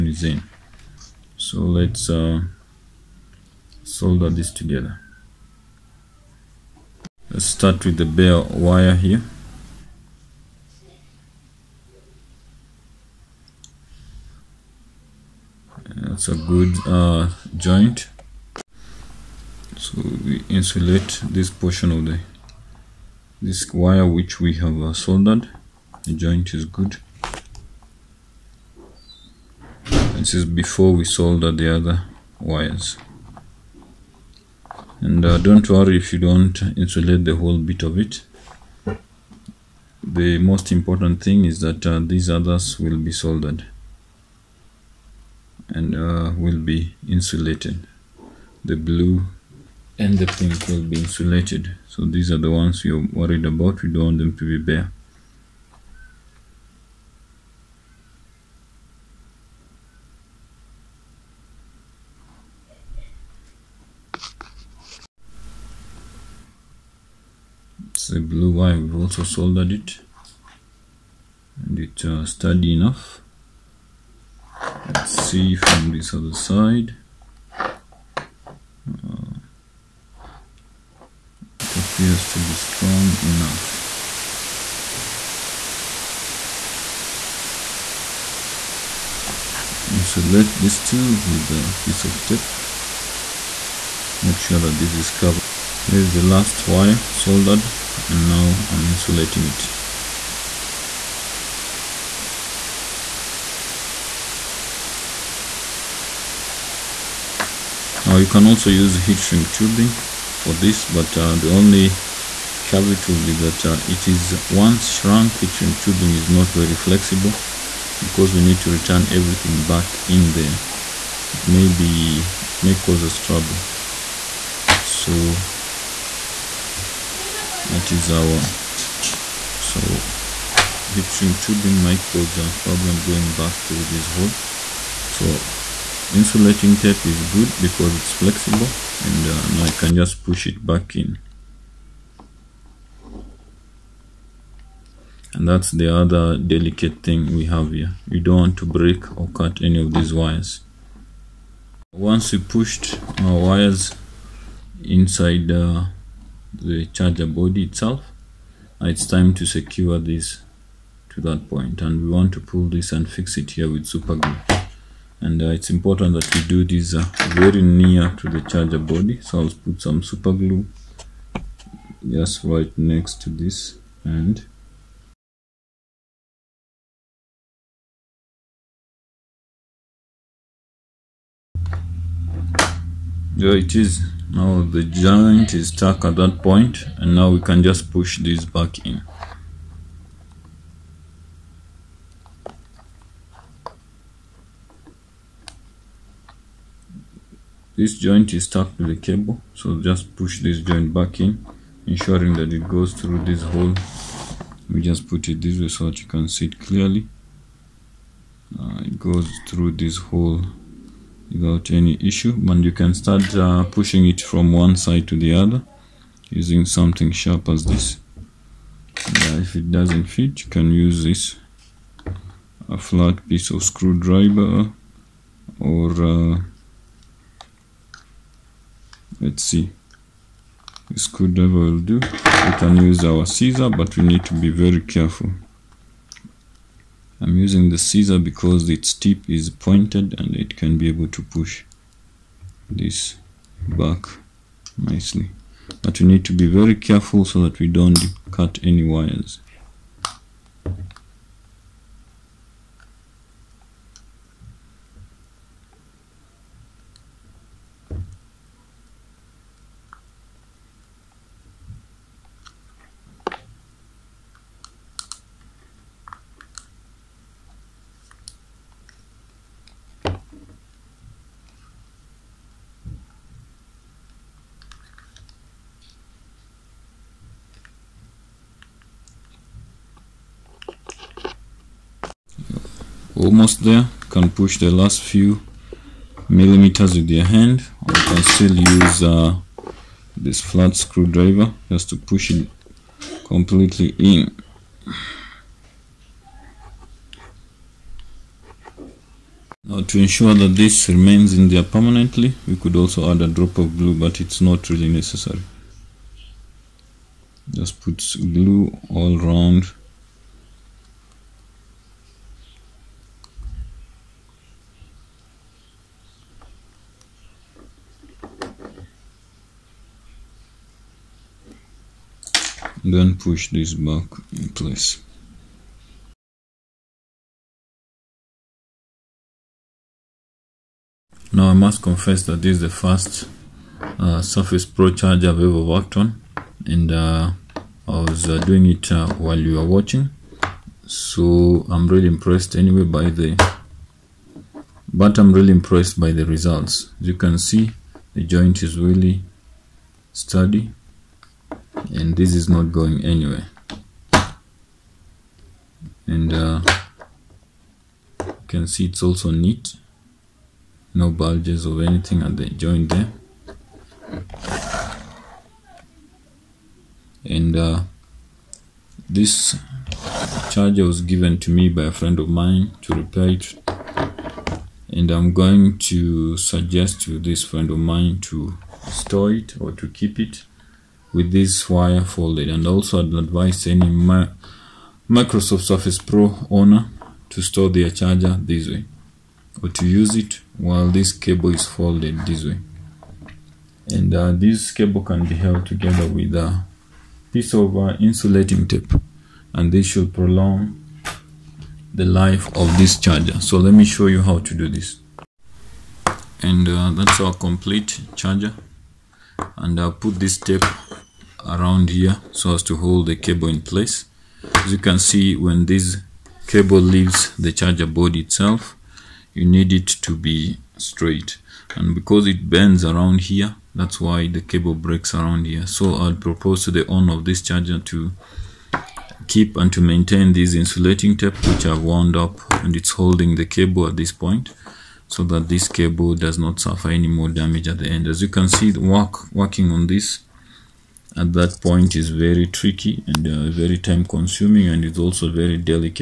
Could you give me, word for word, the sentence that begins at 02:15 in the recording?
So insulating tape is good because it's flexible and uh, now I can just push it back in.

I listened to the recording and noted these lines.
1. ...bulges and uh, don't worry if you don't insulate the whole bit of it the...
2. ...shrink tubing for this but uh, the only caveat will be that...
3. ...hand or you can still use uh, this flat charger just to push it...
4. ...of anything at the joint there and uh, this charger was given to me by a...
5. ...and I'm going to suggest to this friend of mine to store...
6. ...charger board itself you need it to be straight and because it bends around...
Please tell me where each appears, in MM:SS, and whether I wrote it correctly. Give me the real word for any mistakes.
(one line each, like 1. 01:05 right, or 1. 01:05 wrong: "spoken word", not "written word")
1. 00:32 wrong: "wires", not "bulges"
2. 01:49 right
3. 04:47 wrong: "screwdriver", not "charger"
4. 06:01 right
5. 06:14 right
6. 06:57 right.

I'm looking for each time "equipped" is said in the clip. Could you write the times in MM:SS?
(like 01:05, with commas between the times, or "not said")
not said.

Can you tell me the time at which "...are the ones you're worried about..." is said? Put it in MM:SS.
00:52.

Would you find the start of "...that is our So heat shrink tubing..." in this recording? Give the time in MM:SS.
02:07.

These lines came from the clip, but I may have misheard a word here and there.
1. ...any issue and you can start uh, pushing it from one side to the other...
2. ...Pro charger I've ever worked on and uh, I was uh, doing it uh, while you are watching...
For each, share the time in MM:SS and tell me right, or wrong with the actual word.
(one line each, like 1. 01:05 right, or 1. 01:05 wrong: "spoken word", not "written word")
1. 03:31 right
2. 05:34 right.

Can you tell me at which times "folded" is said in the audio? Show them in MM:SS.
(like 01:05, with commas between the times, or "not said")
06:22, 06:31.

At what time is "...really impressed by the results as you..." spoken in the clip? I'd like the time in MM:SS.
05:45.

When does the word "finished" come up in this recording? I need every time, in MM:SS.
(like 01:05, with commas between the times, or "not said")
not said.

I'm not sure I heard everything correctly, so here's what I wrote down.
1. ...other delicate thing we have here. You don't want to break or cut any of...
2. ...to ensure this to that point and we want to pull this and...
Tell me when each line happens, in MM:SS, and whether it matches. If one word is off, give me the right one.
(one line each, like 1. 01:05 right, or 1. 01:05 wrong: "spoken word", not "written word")
1. 02:25 right
2. 02:39 wrong: "secure", not "ensure".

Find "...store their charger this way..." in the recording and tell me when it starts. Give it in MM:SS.
06:27.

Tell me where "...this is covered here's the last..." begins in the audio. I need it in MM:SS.
01:34.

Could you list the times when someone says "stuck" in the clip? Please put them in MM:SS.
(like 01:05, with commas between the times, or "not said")
03:05, 03:18.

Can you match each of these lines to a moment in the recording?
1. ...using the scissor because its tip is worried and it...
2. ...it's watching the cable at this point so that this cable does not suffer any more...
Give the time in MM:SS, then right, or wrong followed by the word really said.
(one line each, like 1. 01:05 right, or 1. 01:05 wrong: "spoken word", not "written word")
1. 03:57 wrong: "pointed", not "worried"
2. 07:12 wrong: "holding", not "watching".